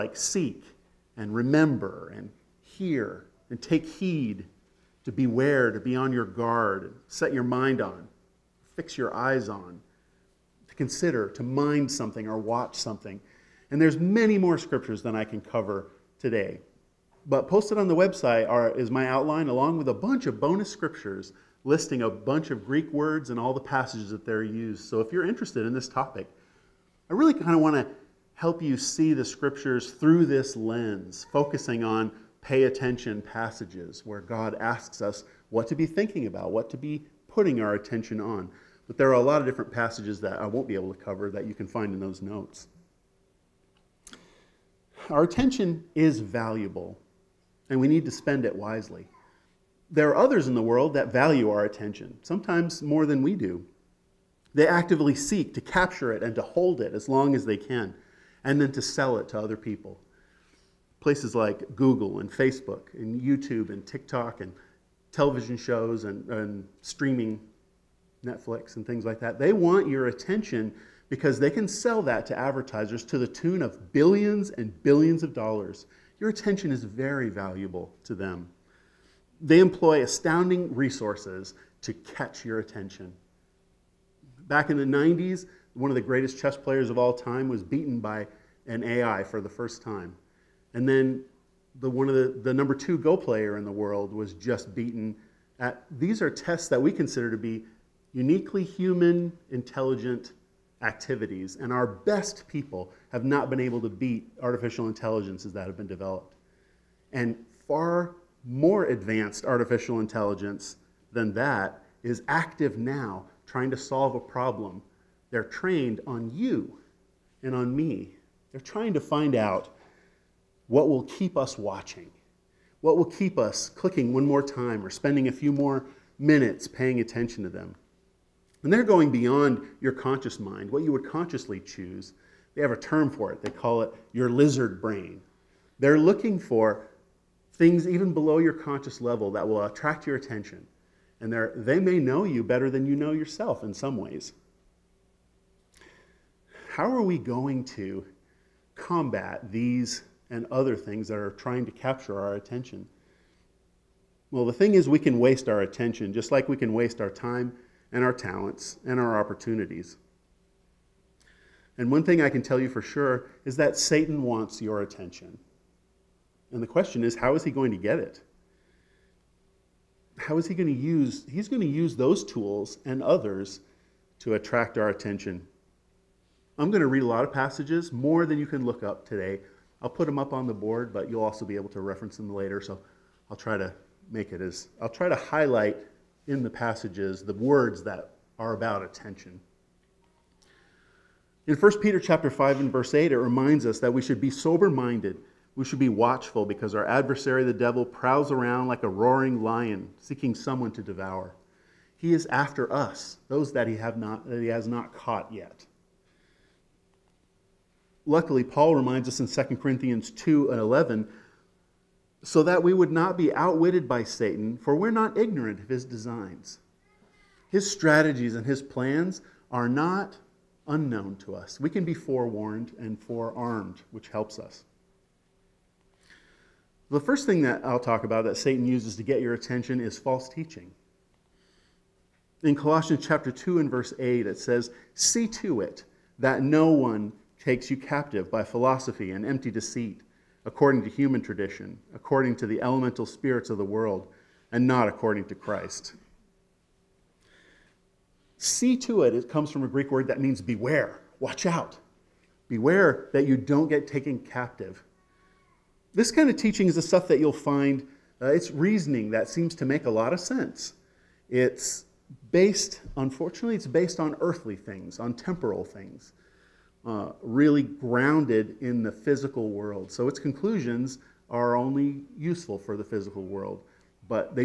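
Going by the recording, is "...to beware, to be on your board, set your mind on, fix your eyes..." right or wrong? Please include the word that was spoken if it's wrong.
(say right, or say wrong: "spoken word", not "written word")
wrong: "guard", not "board".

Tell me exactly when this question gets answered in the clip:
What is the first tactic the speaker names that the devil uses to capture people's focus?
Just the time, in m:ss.
3:49.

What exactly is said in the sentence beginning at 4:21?
It's based, unfortunately, it's based on earthly things, on temporal things.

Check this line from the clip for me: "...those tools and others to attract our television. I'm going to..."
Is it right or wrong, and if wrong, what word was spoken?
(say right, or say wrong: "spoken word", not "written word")
wrong: "attention", not "television".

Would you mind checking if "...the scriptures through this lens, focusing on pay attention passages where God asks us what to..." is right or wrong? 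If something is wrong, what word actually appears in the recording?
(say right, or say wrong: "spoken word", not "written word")
right.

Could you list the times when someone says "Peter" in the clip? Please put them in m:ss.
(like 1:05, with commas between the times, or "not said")
3:11.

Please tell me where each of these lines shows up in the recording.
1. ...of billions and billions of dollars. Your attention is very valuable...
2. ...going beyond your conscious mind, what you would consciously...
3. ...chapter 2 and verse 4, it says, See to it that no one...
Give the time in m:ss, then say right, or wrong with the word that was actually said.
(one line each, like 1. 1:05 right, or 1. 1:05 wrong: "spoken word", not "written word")
1. 1:13 right
2. 2:08 right
3. 3:53 wrong: "8", not "4".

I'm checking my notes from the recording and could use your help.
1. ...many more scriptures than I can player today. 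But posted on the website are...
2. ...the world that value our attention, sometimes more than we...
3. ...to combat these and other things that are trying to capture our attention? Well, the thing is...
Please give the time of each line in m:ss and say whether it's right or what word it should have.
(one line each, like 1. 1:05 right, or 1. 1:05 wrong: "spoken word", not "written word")
1. 0:13 wrong: "cover", not "player"
2. 0:50 right
3. 2:27 right.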